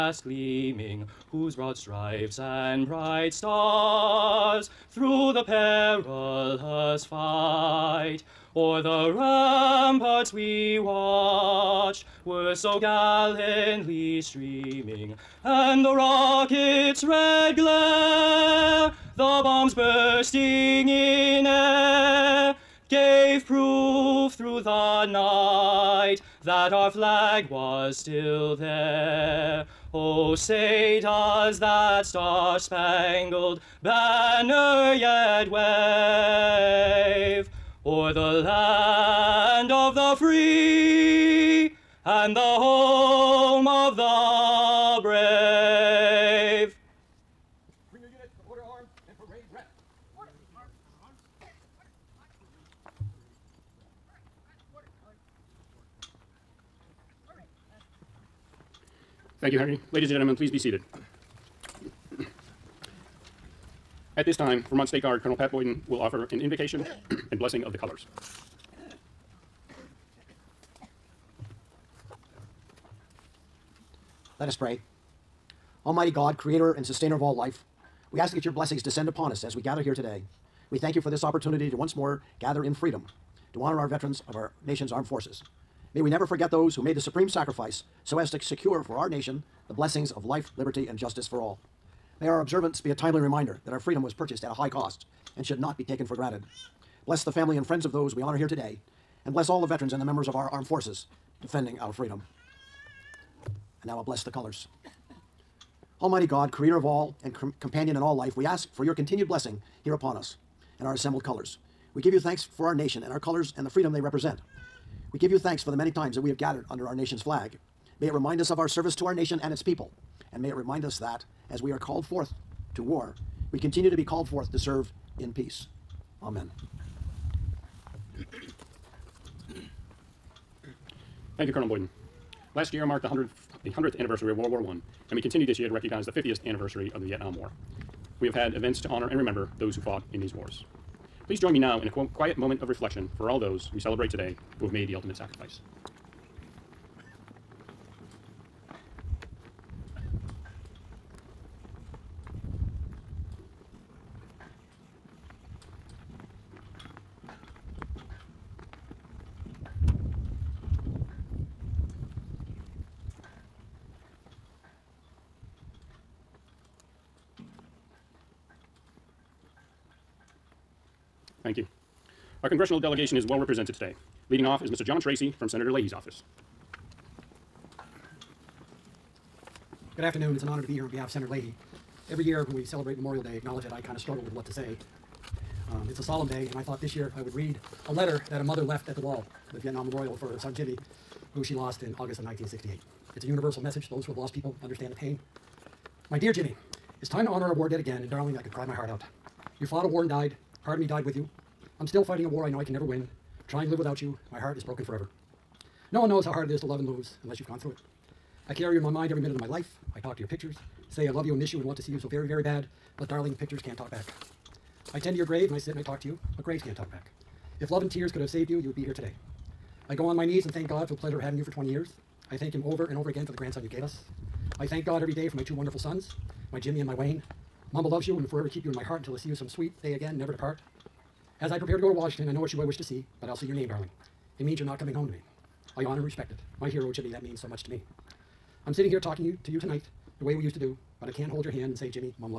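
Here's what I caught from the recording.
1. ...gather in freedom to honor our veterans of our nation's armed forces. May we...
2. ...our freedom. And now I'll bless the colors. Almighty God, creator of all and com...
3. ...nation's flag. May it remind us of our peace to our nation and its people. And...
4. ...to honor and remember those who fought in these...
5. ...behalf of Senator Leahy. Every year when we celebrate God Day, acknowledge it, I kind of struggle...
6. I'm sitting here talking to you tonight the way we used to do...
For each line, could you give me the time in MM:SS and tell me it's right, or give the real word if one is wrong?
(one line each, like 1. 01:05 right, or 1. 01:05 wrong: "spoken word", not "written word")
1. 01:22 right
2. 01:41 right
3. 01:56 wrong: "service", not "peace"
4. 02:18 right
5. 03:00 wrong: "Memorial", not "God"
6. 03:58 right.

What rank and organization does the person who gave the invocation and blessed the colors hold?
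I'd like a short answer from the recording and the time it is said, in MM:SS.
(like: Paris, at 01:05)
Vermont State Guard Colonel, at 01:04.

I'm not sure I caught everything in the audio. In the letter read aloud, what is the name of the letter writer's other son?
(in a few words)
Wayne.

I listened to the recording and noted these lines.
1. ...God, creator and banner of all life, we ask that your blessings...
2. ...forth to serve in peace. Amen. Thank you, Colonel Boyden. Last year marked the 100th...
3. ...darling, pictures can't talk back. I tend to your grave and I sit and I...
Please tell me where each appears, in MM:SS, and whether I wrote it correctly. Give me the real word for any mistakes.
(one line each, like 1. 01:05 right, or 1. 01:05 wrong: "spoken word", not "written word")
1. 01:16 wrong: "sustainer", not "banner"
2. 02:04 right
3. 03:33 right.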